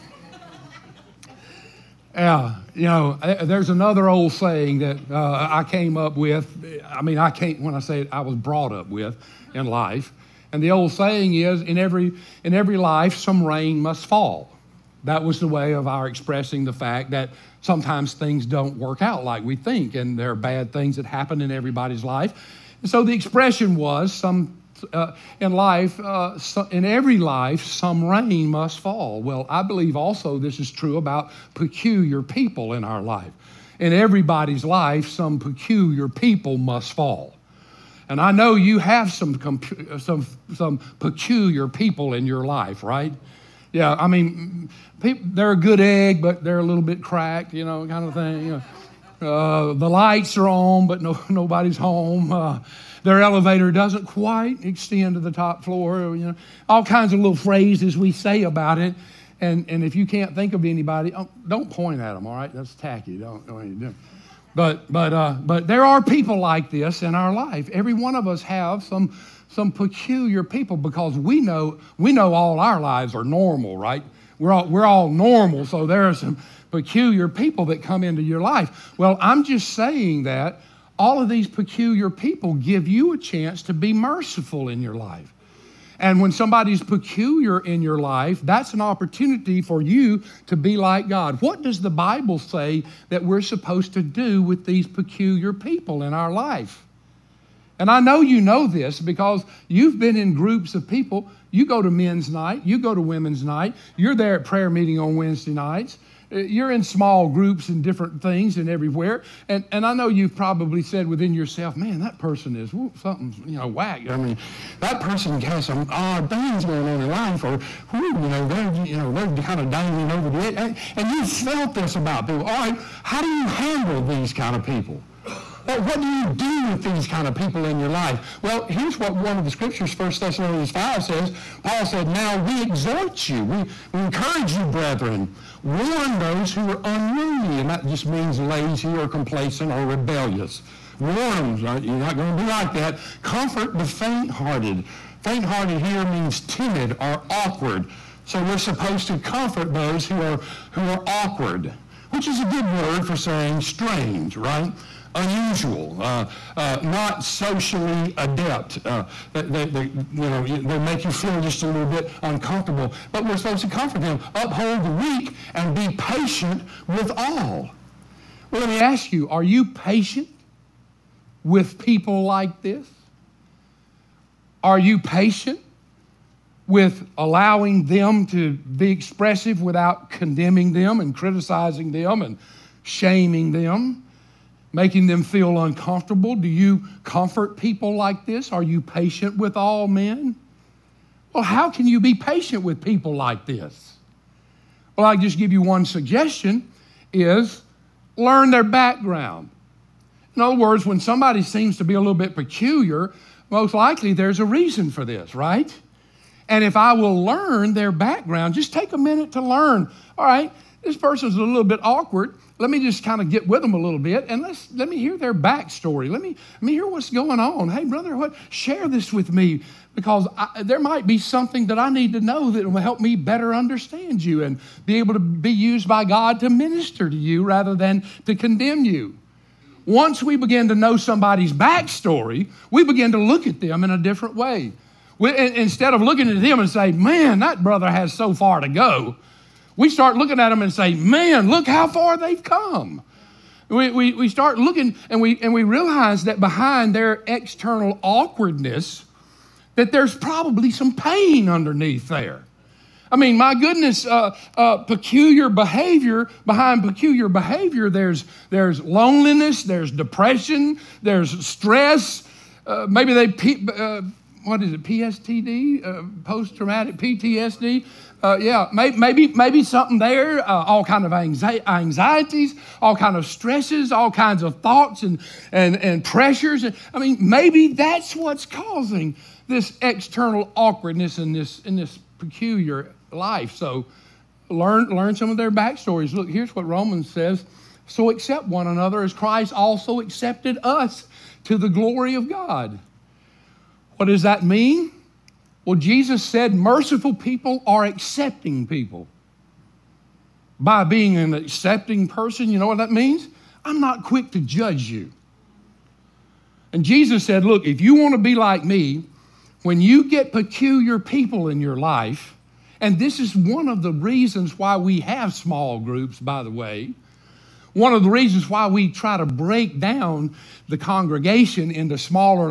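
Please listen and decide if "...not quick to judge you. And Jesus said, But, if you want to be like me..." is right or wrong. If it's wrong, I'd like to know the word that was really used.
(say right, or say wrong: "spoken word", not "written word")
wrong: "Look", not "But".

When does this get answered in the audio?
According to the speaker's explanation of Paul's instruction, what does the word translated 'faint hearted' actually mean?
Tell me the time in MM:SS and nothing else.
02:26.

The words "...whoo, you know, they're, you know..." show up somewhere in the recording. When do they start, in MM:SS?
01:57.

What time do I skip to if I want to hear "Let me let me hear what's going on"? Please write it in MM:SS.
03:36.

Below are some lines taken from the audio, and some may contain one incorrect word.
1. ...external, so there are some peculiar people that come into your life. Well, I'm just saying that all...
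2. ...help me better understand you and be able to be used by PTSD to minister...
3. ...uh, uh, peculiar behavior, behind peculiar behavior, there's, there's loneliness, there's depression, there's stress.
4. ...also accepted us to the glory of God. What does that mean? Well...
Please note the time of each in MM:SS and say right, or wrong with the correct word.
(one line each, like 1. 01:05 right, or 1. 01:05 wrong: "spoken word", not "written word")
1. 01:15 wrong: "normal", not "external"
2. 03:42 wrong: "God", not "PTSD"
3. 04:14 right
4. 04:49 right.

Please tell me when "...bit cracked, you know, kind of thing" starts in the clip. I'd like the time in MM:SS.
00:46.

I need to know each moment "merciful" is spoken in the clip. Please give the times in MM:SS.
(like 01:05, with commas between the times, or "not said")
01:23, 04:56.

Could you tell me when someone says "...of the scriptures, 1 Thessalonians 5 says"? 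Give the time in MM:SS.
02:09.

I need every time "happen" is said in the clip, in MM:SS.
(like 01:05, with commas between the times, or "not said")
00:21.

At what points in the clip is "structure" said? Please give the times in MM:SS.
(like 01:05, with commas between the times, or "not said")
not said.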